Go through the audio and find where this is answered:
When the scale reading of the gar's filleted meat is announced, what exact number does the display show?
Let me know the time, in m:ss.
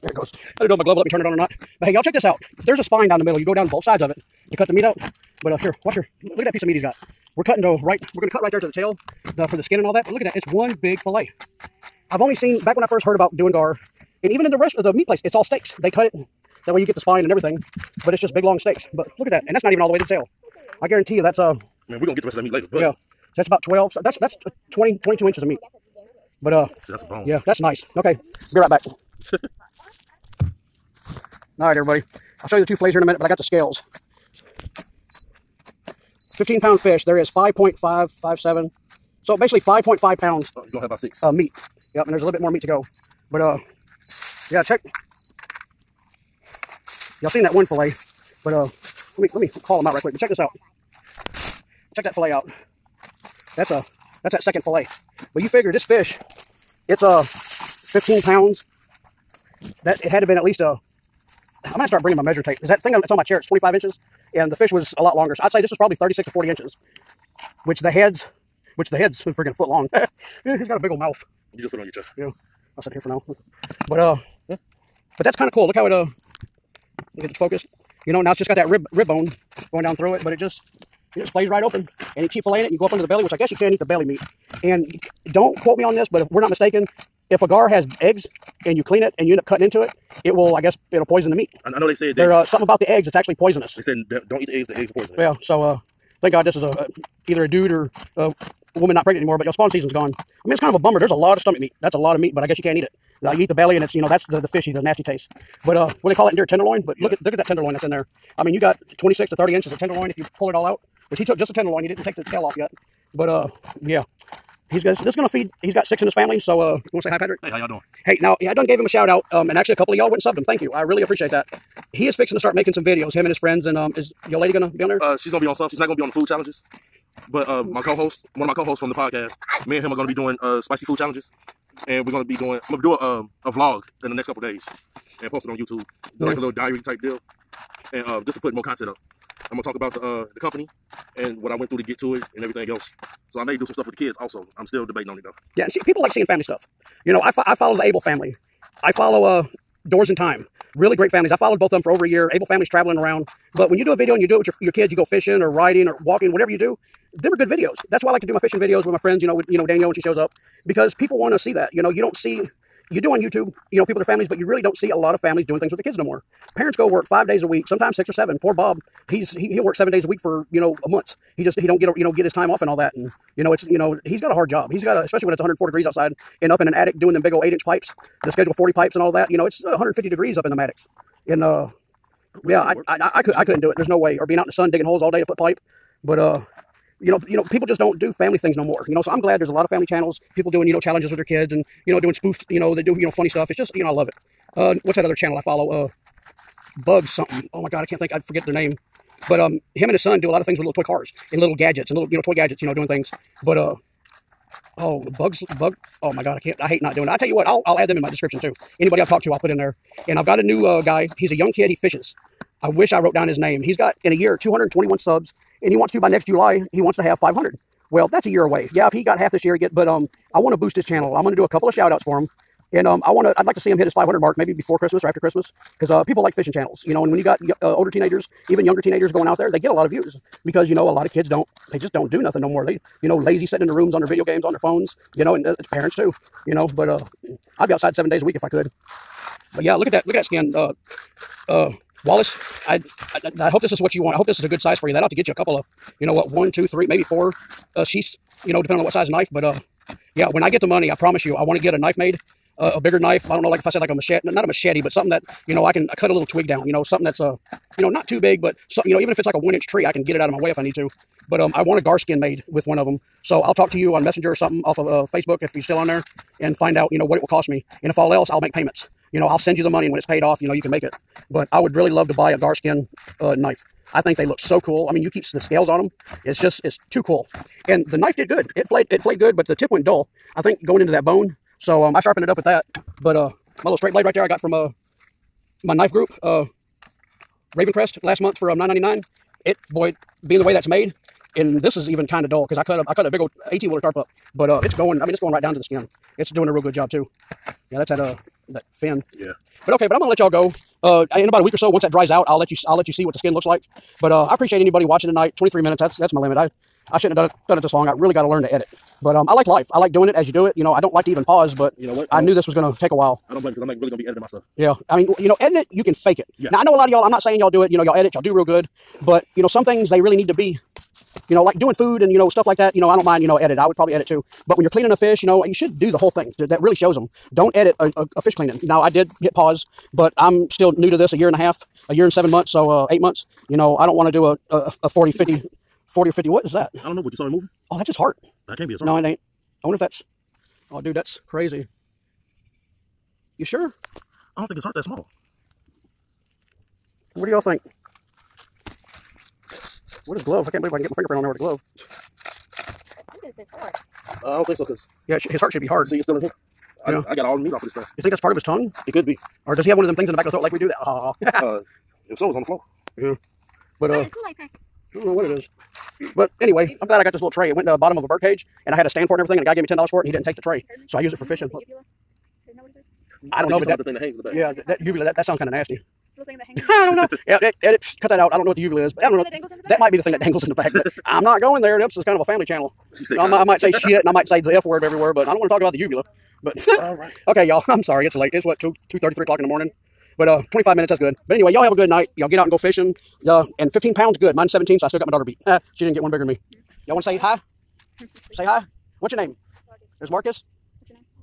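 0:37.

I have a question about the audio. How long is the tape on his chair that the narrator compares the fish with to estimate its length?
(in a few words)
25 inches.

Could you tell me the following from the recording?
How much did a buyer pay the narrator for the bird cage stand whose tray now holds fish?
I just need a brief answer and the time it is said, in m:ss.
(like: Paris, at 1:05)
10 dollars, at 6:09.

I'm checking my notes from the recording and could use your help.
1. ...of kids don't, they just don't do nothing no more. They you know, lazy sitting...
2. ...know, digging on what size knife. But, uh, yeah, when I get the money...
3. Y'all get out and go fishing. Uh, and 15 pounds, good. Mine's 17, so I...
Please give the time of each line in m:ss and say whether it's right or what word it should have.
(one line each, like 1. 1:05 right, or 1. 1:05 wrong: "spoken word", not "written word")
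1. 3:51 right
2. 4:08 wrong: "depending", not "digging"
3. 6:32 right.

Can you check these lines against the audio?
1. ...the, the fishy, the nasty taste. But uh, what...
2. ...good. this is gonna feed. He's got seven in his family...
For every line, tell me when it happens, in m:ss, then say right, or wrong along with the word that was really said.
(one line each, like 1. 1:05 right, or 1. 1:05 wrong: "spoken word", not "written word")
1. 1:44 right
2. 1:54 wrong: "six", not "seven".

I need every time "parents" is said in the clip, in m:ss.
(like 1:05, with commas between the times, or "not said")
2:46, 3:55.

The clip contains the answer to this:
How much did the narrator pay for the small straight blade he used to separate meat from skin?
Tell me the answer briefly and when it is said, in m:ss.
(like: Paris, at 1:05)
$9.99, at 4:48.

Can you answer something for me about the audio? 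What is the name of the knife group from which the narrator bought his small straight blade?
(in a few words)
Ravencrest.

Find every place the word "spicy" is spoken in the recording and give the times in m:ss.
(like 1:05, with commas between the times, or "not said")
2:10.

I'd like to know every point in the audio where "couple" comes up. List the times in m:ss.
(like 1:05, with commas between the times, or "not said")
1:59, 2:14, 3:41, 4:05.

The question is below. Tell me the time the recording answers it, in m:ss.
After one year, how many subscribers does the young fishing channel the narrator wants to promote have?
3:34.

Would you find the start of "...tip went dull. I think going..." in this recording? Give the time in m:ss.
4:39.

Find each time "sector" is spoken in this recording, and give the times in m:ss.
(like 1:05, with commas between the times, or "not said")
not said.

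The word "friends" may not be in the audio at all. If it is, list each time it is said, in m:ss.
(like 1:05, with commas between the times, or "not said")
2:03, 2:38.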